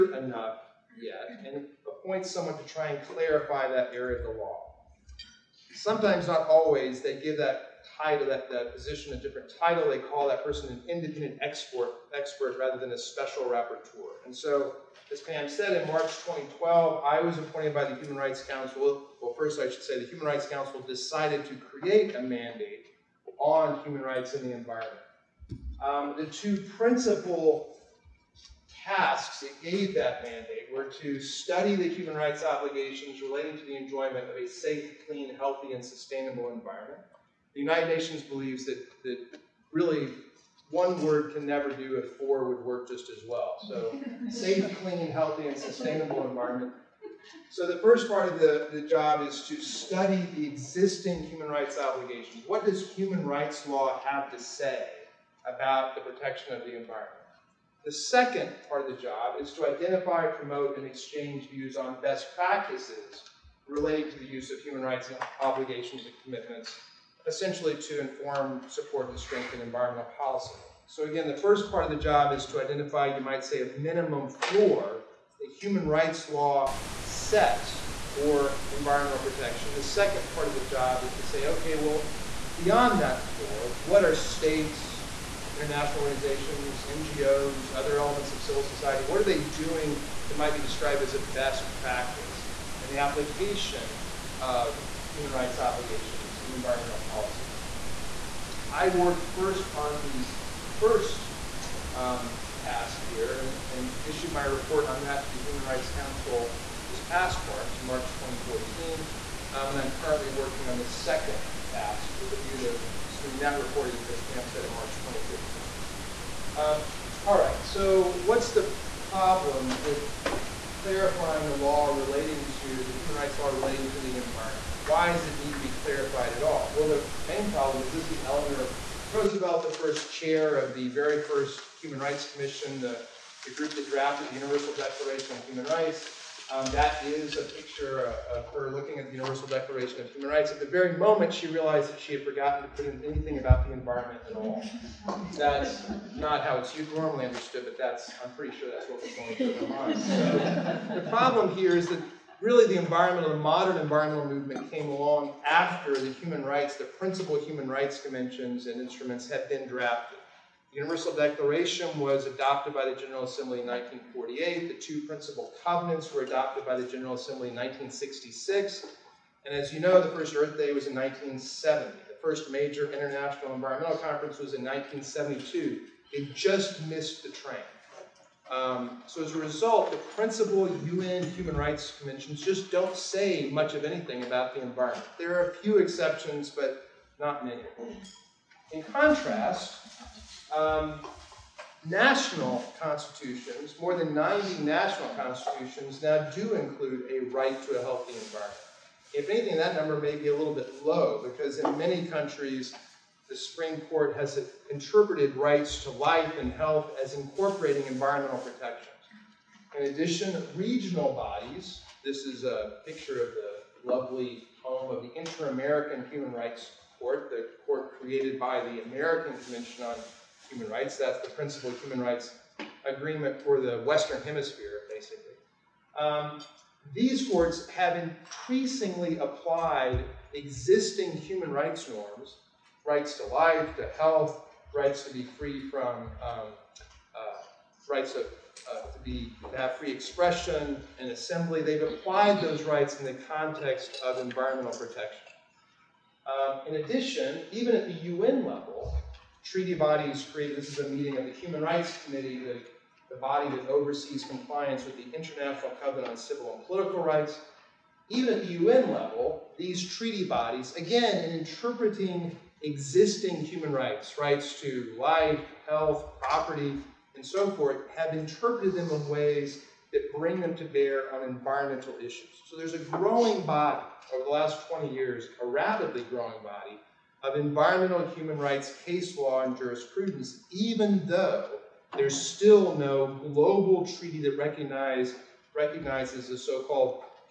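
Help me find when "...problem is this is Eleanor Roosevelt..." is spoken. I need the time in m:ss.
2:07.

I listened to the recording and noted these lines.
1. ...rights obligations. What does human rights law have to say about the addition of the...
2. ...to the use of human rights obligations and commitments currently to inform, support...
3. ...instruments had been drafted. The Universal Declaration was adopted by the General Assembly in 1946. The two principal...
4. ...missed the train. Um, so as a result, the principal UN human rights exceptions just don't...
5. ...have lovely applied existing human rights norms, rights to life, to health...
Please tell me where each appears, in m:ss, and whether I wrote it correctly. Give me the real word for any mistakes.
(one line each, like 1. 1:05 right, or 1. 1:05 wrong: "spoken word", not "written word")
1. 0:51 wrong: "protection", not "addition"
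2. 1:04 wrong: "essentially", not "currently"
3. 2:38 wrong: "1948", not "1946"
4. 2:56 wrong: "conventions", not "exceptions"
5. 3:47 wrong: "increasingly", not "lovely".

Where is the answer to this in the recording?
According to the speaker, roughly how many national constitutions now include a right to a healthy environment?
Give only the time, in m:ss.
3:13.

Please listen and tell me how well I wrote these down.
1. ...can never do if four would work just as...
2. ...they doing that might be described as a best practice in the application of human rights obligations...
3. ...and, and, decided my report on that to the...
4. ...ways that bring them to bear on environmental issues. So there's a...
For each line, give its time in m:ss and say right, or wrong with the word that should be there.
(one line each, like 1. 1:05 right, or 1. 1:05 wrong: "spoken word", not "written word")
1. 0:41 right
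2. 1:29 right
3. 1:43 wrong: "issued", not "decided"
4. 4:29 right.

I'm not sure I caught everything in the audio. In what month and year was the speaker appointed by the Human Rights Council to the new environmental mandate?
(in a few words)
March 2012.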